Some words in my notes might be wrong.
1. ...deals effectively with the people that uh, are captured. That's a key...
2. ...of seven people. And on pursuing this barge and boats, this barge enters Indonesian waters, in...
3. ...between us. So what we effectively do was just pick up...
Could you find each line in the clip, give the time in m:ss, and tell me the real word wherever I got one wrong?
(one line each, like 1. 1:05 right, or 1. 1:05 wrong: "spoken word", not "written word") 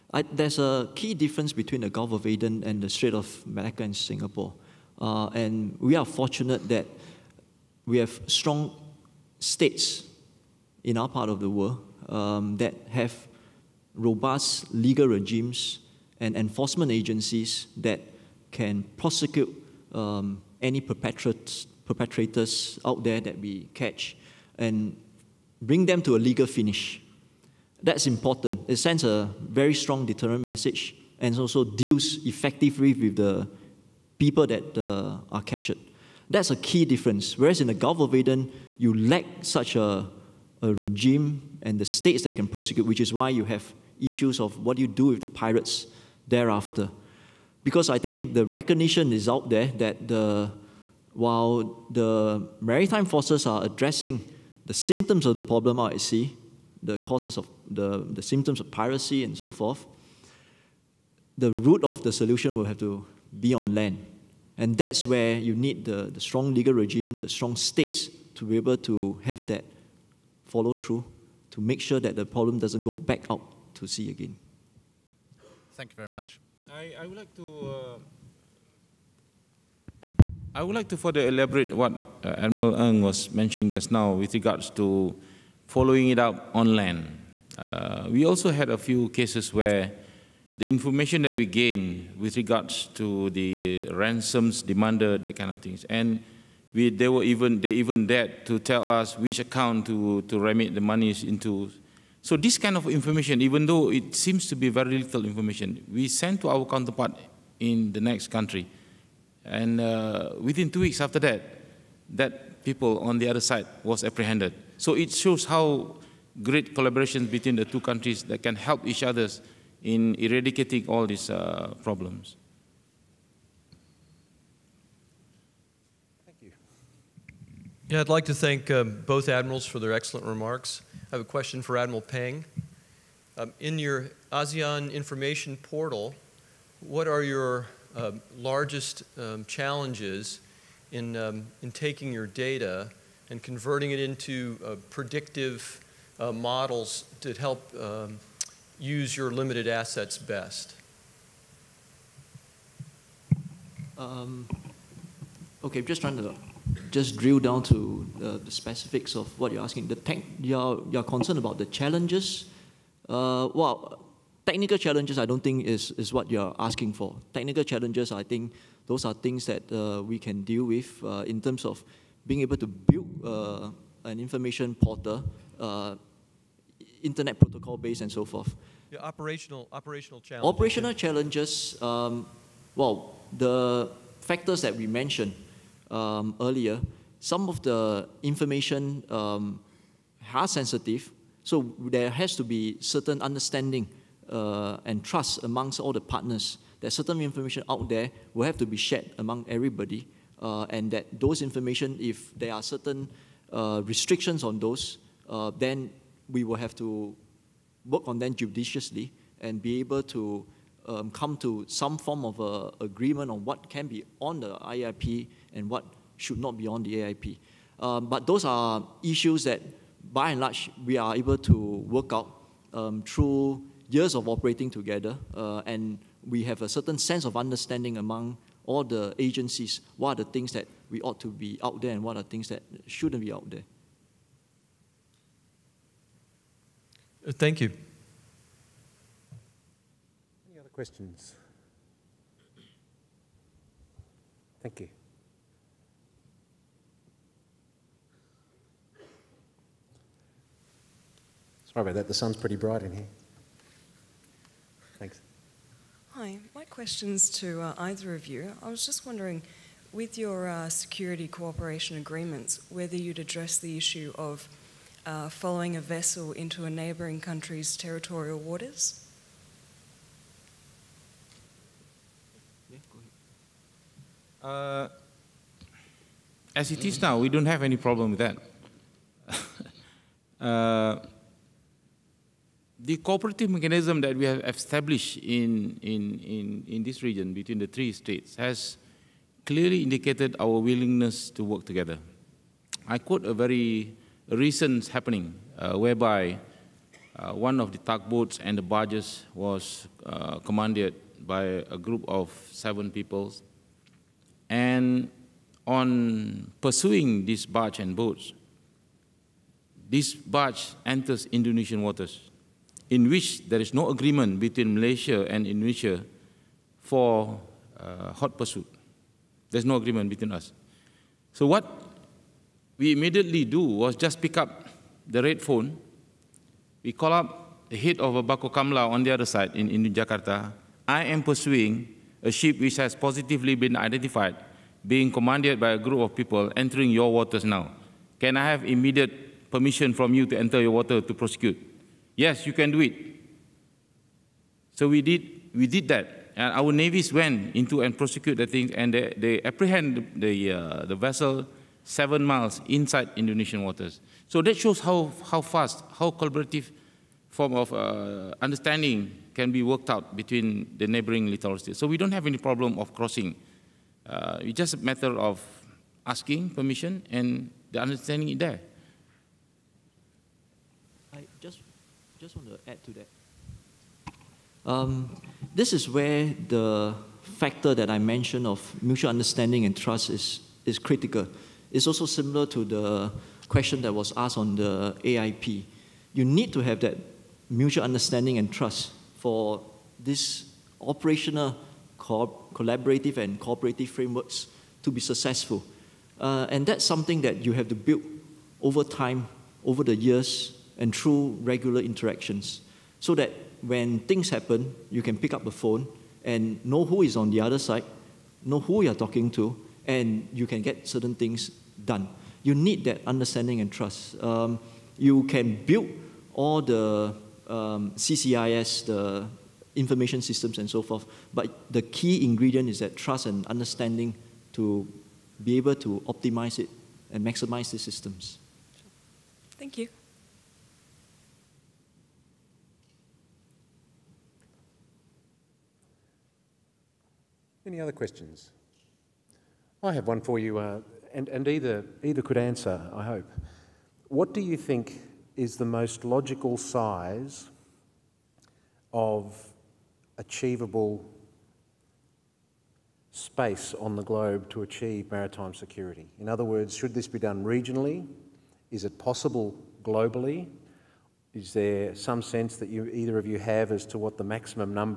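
1. 0:31 right
2. 5:02 right
3. 5:20 wrong: "immediately", not "effectively".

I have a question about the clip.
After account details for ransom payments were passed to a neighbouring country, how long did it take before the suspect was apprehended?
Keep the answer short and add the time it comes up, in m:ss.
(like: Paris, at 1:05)
2 weeks, at 1:50.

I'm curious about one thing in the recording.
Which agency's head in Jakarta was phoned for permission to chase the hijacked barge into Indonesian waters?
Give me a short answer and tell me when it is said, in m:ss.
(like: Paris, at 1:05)
Bakorkamla, at 5:28.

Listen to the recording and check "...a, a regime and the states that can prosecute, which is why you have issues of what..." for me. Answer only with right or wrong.
right.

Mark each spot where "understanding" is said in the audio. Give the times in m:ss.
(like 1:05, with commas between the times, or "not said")
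3:13, 3:47, 5:58, 6:07, 6:19, 6:27, 6:53, 7:03.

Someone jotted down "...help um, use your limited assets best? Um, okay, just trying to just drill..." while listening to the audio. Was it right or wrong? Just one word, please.
right.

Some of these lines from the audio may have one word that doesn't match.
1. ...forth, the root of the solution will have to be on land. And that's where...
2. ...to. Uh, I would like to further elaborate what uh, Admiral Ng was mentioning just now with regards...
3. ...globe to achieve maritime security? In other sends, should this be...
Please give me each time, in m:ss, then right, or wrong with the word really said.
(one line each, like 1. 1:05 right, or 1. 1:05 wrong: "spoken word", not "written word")
1. 0:59 right
2. 1:17 right
3. 7:34 wrong: "words", not "sends".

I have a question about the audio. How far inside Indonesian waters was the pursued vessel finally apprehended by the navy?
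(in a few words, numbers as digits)
7 miles.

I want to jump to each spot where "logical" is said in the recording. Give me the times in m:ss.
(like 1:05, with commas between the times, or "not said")
7:26.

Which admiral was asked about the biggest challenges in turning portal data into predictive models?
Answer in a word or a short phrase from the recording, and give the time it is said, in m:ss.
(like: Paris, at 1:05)
Admiral Peng, at 2:11.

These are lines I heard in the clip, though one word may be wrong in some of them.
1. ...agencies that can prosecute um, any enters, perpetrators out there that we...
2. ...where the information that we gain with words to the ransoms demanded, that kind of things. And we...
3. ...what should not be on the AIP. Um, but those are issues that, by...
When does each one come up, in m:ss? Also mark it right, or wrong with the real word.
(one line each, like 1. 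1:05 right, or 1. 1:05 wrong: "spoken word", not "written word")
1. 0:16 wrong: "perpetrators", not "enters"
2. 1:29 wrong: "regards", not "words"
3. 3:35 right.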